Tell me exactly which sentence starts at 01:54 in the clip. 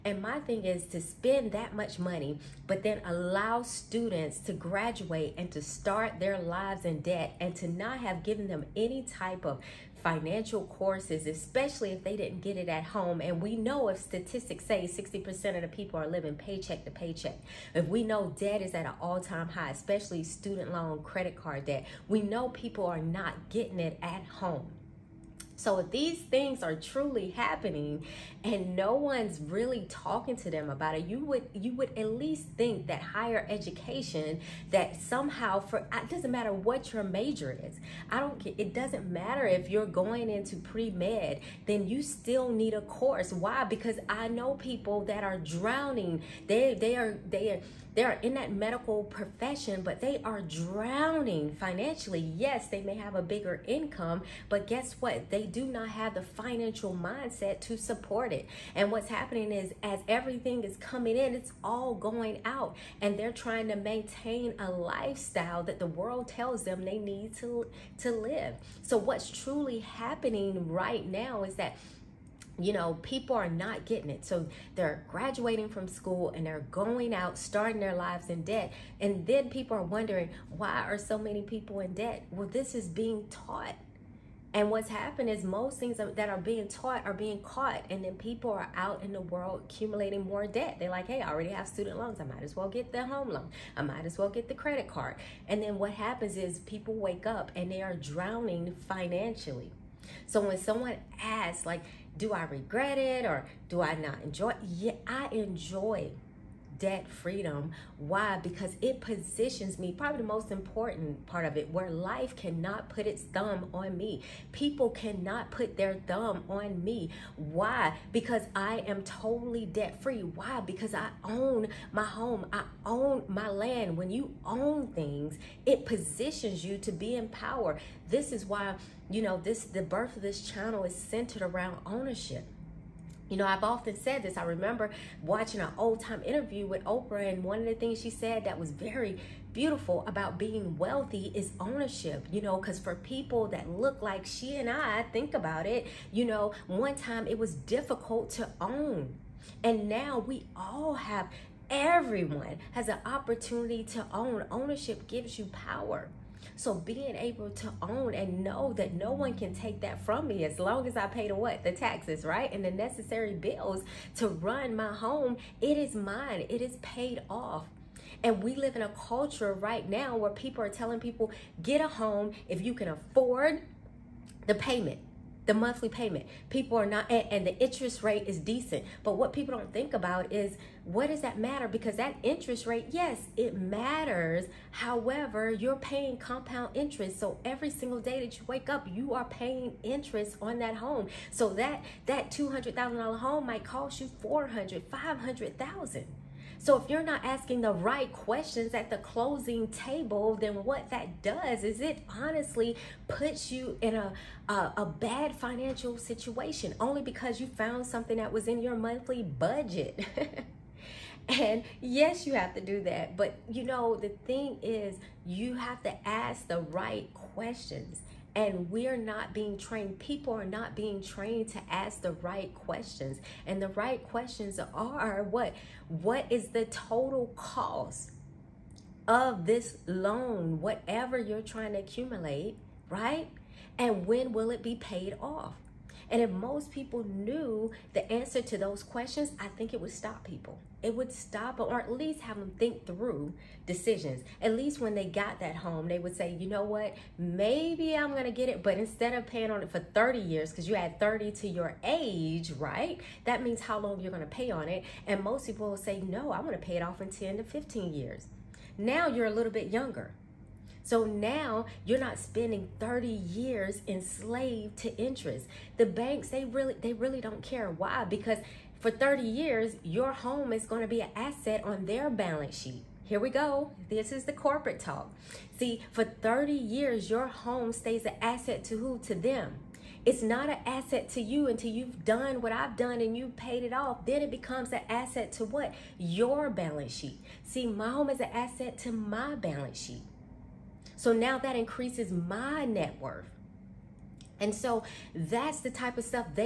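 People cannot put their thumb on me.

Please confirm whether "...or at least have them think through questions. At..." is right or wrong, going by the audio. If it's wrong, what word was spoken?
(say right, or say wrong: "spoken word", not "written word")
wrong: "decisions", not "questions".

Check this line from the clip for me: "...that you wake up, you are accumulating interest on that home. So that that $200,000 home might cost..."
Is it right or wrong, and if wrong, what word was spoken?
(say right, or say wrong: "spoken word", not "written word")
wrong: "paying", not "accumulating".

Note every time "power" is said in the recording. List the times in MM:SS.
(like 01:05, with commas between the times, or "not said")
02:07, 02:35.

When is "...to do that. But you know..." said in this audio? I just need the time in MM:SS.
03:32.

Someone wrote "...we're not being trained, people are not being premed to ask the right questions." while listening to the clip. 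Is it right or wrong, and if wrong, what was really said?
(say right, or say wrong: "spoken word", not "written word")
wrong: "trained", not "premed".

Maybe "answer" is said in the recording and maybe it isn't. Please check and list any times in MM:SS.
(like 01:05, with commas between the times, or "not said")
03:58.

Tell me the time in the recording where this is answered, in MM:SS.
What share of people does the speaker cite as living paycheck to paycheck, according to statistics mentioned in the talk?
00:14.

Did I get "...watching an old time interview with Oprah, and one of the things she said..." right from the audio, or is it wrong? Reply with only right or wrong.
right.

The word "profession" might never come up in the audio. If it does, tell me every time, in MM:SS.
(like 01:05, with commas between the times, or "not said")
00:49.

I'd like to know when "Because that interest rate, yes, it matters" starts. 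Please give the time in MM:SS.
03:01.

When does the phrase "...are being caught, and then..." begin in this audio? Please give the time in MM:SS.
01:27.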